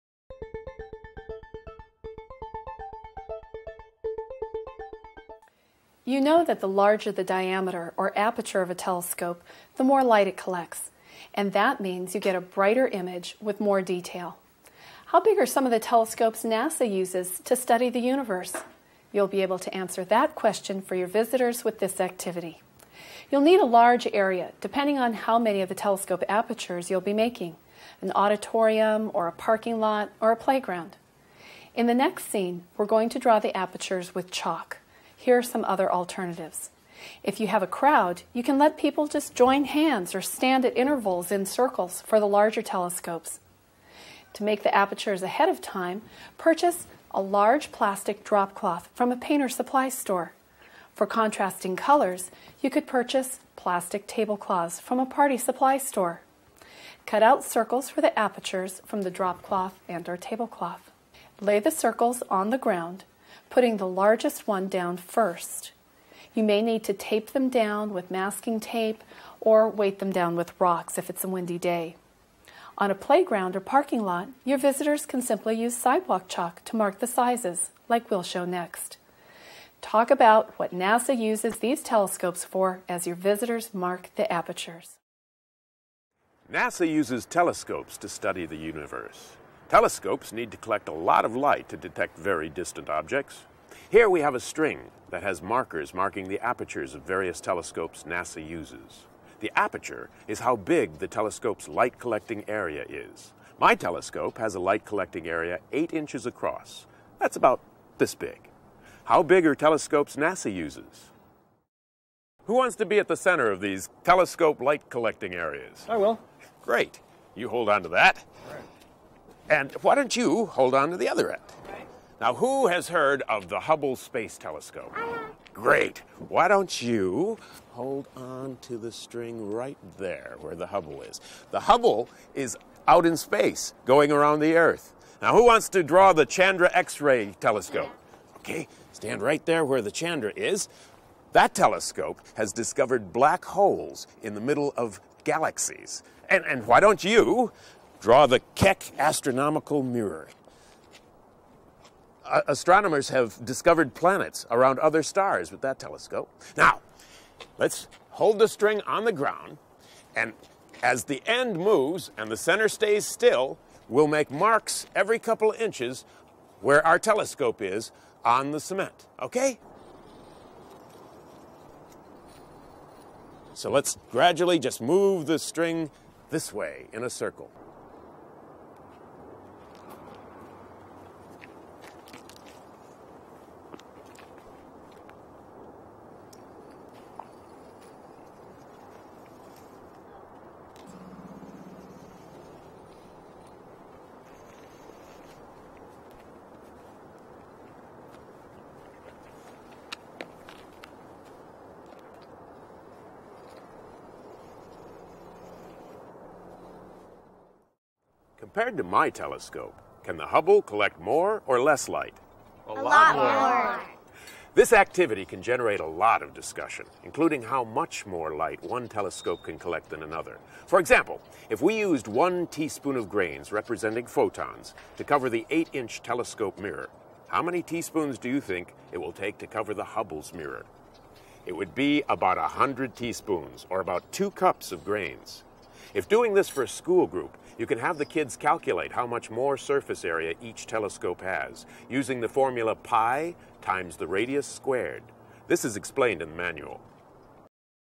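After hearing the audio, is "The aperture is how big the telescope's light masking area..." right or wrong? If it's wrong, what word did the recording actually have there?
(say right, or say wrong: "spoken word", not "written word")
wrong: "collecting", not "masking".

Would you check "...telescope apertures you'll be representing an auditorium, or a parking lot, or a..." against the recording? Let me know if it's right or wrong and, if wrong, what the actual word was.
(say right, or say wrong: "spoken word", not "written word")
wrong: "making", not "representing".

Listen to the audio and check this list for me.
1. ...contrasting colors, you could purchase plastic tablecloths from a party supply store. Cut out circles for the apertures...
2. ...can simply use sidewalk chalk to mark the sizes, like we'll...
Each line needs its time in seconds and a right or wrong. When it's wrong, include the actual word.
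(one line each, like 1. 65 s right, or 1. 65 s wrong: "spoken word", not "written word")
1. 51 s right
2. 75 s right.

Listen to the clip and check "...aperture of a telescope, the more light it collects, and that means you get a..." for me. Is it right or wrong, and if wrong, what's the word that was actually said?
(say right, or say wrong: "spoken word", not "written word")
right.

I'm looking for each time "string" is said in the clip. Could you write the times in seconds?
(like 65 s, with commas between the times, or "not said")
94 s, 128 s, 158 s, 175 s.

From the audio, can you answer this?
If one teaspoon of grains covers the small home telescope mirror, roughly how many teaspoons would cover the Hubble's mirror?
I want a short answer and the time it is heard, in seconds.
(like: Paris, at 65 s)
100, at 232 s.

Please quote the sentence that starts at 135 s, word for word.
Now, who wants to draw the Chandra X ray telescope?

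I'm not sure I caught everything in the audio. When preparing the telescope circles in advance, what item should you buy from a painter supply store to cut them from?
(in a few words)
large plastic drop cloth.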